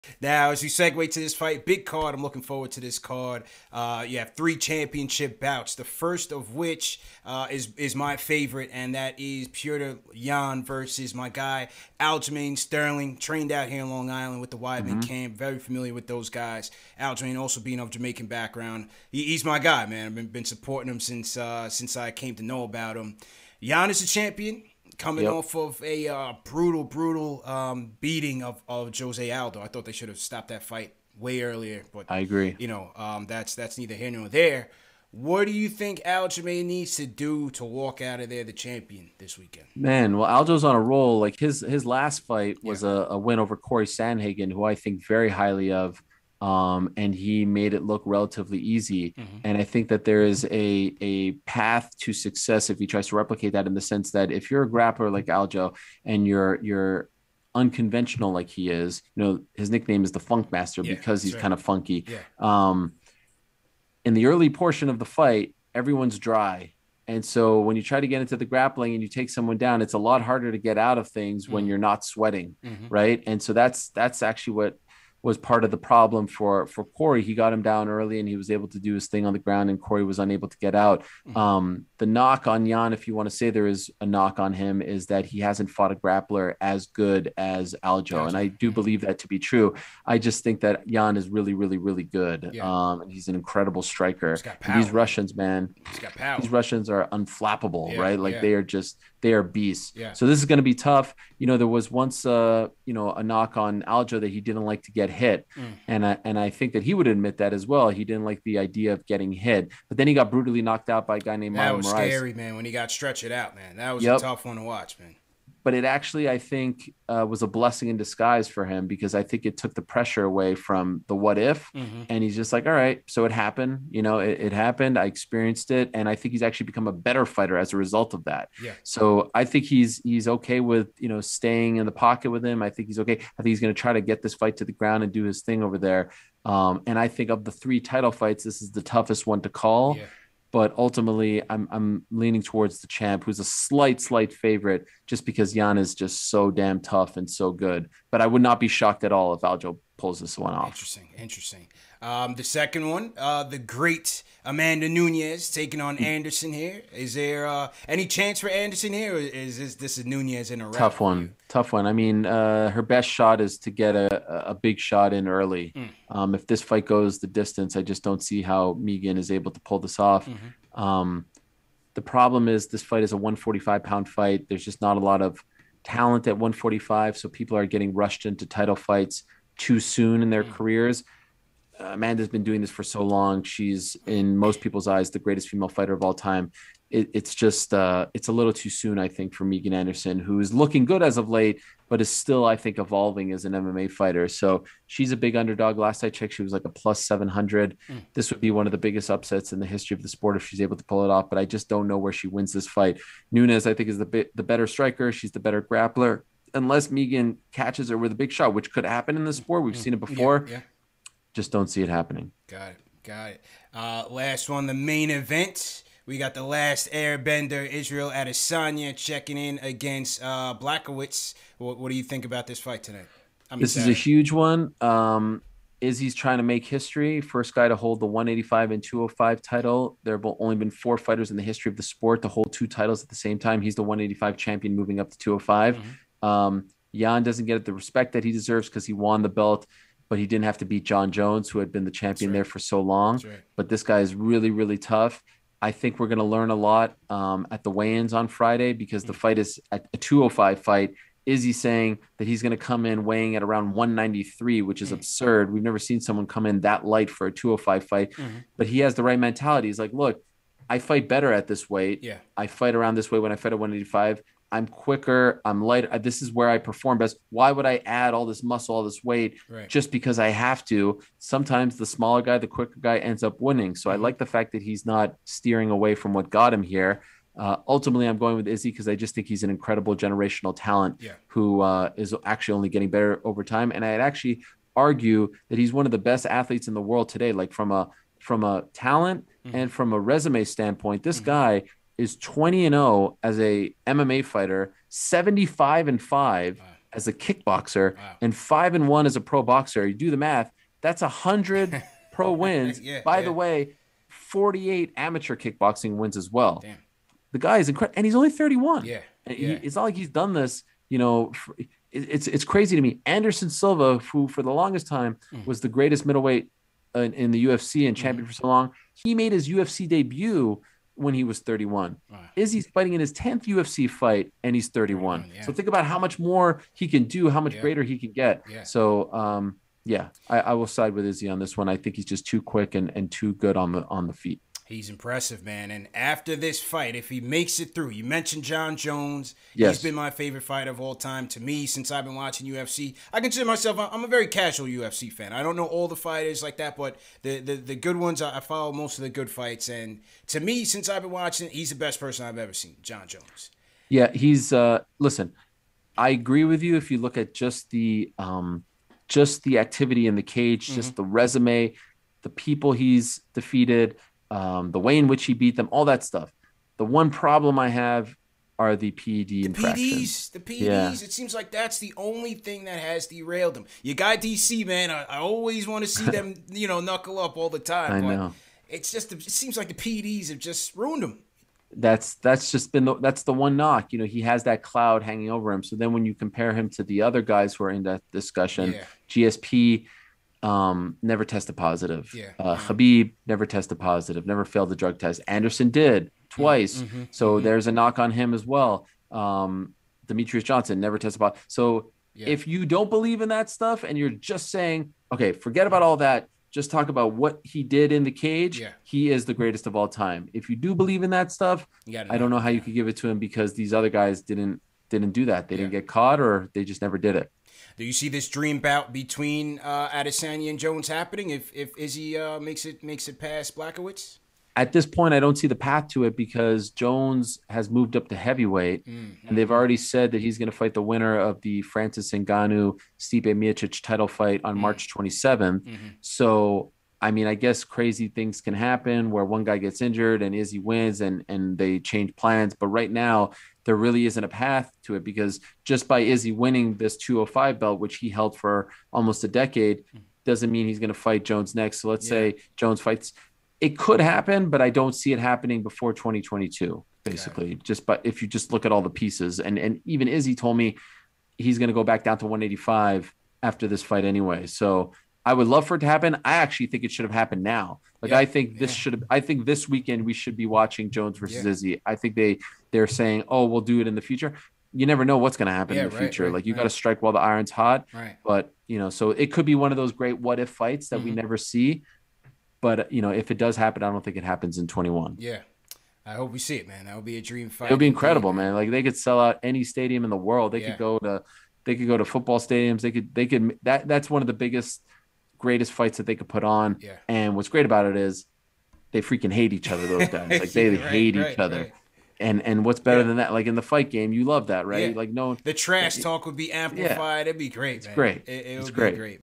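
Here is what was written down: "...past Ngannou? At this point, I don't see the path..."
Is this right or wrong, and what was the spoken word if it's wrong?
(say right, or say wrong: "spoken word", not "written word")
wrong: "Blachowicz", not "Ngannou".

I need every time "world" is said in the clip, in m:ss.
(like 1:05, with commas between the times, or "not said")
4:46, 8:10.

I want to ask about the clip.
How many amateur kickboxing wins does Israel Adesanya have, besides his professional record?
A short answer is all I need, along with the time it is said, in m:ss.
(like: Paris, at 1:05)
48, at 5:04.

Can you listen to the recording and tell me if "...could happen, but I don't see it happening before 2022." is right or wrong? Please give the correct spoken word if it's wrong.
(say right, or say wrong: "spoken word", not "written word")
right.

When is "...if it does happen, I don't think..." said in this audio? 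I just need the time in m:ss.
8:03.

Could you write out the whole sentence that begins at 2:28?
But I would not be shocked at all if Aljo pulls this one off.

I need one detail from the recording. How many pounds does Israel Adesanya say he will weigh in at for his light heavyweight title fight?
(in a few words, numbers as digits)
193.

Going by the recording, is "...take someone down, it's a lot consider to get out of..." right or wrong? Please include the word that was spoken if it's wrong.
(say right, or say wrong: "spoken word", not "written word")
wrong: "harder", not "consider".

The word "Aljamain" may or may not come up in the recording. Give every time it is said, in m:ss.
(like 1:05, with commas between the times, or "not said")
0:11, 0:16, 0:36.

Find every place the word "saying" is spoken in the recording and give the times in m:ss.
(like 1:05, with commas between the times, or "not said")
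4:11, 6:44, 7:52.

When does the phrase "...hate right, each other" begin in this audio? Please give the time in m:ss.
8:20.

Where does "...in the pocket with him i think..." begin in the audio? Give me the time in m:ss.
2:11.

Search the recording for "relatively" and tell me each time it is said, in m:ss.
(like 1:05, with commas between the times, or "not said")
0:48.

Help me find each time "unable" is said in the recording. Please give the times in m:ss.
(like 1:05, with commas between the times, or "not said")
1:20.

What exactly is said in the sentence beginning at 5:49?
And to me, since I've been watching, he's the best person I've ever seen, Jon Jones.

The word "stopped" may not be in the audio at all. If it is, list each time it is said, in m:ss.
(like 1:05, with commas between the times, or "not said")
0:30.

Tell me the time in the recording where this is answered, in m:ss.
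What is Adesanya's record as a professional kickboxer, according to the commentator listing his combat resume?
4:54.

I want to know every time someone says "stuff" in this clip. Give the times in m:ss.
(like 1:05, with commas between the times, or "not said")
6:06, 6:43, 6:51.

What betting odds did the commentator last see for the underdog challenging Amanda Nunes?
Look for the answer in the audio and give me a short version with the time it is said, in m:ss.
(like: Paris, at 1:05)
+700, at 3:16.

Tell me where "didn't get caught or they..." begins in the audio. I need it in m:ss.
6:55.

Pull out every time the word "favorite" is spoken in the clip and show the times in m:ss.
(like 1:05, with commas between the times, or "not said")
0:08, 2:24, 5:40.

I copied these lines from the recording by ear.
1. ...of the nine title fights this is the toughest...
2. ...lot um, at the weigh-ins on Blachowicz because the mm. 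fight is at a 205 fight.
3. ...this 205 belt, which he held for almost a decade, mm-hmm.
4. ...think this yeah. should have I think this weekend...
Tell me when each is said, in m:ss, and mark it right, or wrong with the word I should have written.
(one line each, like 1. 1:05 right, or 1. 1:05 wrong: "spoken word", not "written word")
1. 2:17 wrong: "three", not "nine"
2. 4:06 wrong: "Friday", not "Blachowicz"
3. 7:26 right
4. 7:48 right.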